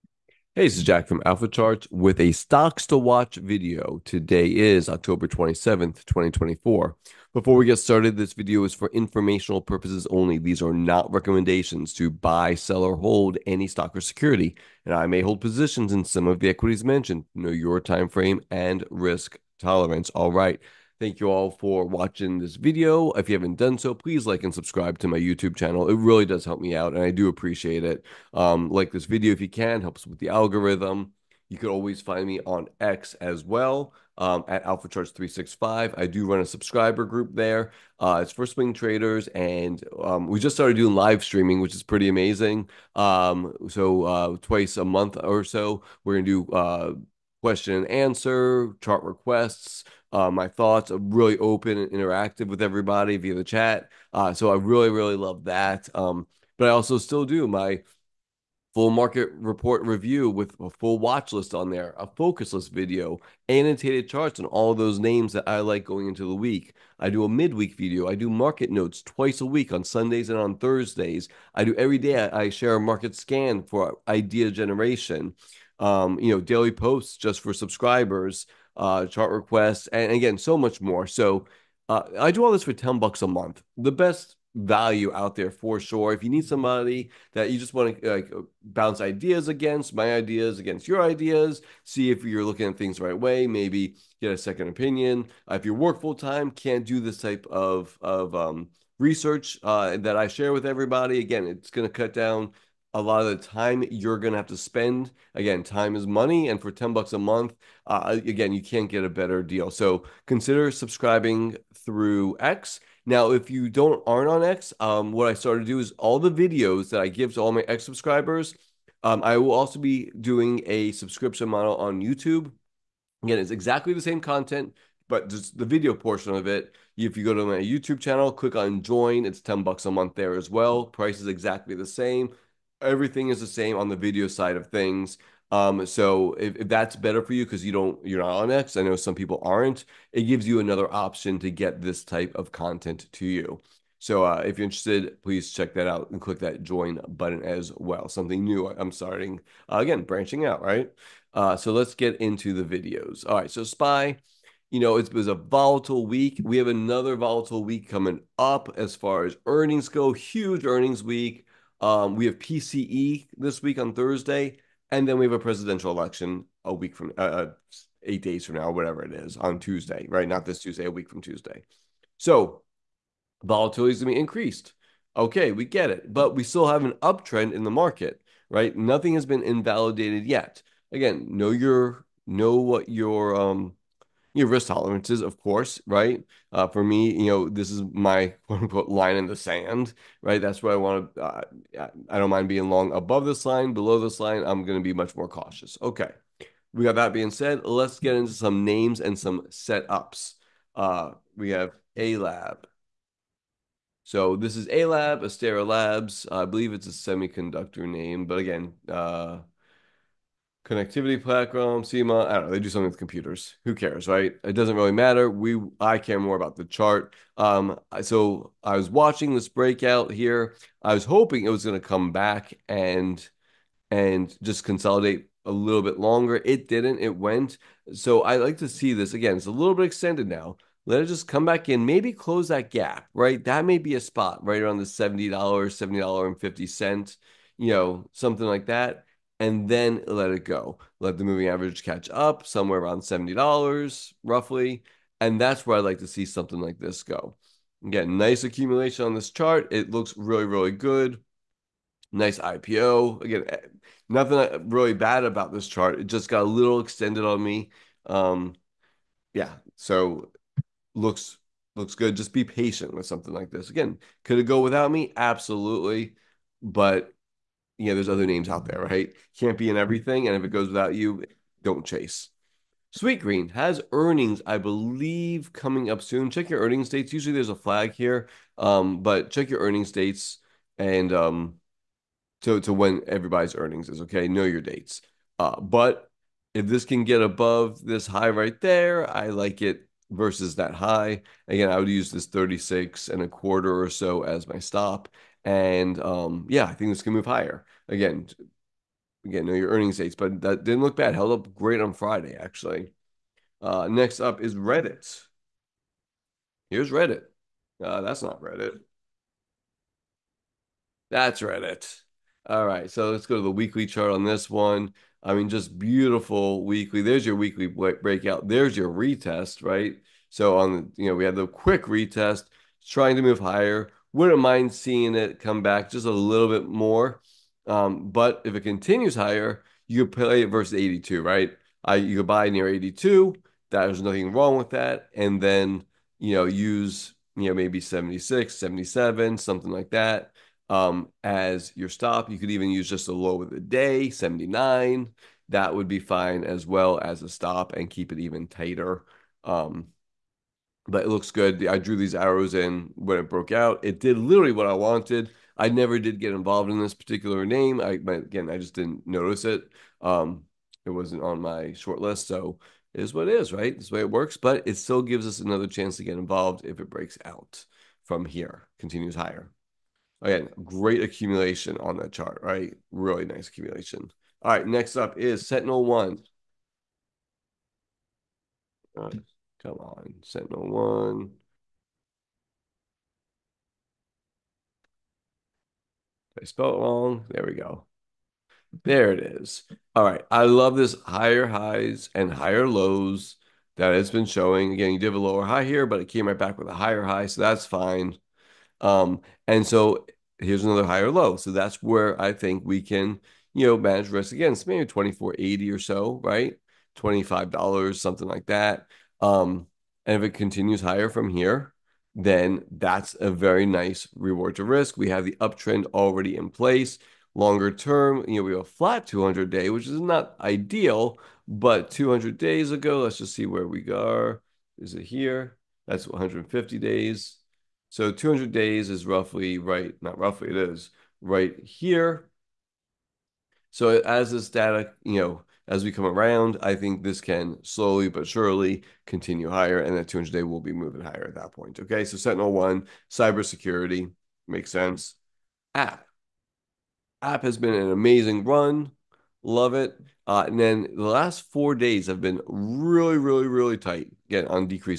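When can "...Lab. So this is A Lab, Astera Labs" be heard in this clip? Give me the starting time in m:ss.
3:22.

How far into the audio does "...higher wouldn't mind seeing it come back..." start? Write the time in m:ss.
5:23.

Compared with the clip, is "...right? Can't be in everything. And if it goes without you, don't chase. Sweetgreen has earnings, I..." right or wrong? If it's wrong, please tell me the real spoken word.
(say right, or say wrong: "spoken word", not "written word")
right.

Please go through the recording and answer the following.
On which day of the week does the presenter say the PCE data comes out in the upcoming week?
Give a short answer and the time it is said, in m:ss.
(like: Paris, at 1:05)
Thursday, at 2:43.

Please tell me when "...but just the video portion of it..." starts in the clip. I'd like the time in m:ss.
2:05.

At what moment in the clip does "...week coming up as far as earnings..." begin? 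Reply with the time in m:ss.
2:37.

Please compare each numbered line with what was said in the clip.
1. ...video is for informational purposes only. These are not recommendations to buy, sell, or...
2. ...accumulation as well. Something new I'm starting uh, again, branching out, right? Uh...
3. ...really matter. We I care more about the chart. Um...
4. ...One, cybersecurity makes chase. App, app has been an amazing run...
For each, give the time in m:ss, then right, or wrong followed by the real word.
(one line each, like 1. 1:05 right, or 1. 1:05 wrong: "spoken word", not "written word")
1. 0:08 right
2. 2:27 wrong: "button", not "accumulation"
3. 3:34 right
4. 7:22 wrong: "sense", not "chase".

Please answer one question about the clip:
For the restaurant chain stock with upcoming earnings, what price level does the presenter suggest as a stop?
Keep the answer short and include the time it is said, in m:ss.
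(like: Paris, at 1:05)
36 and a quarter, at 4:52.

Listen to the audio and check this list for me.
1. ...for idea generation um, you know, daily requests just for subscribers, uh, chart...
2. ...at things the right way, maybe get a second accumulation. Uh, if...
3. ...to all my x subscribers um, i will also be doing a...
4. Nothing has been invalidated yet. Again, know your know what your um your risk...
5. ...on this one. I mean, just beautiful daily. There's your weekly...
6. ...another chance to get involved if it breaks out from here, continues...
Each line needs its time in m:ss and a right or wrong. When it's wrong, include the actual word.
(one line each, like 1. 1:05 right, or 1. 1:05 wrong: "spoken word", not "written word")
1. 1:13 wrong: "posts", not "requests"
2. 1:32 wrong: "opinion", not "accumulation"
3. 1:57 right
4. 2:58 right
5. 5:14 wrong: "weekly", not "daily"
6. 6:05 right.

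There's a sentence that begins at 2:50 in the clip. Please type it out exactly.
Not this Tuesday, a week from Tuesday.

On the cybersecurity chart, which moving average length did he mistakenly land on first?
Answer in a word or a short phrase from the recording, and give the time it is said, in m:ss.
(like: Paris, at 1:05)
150 days, at 7:06.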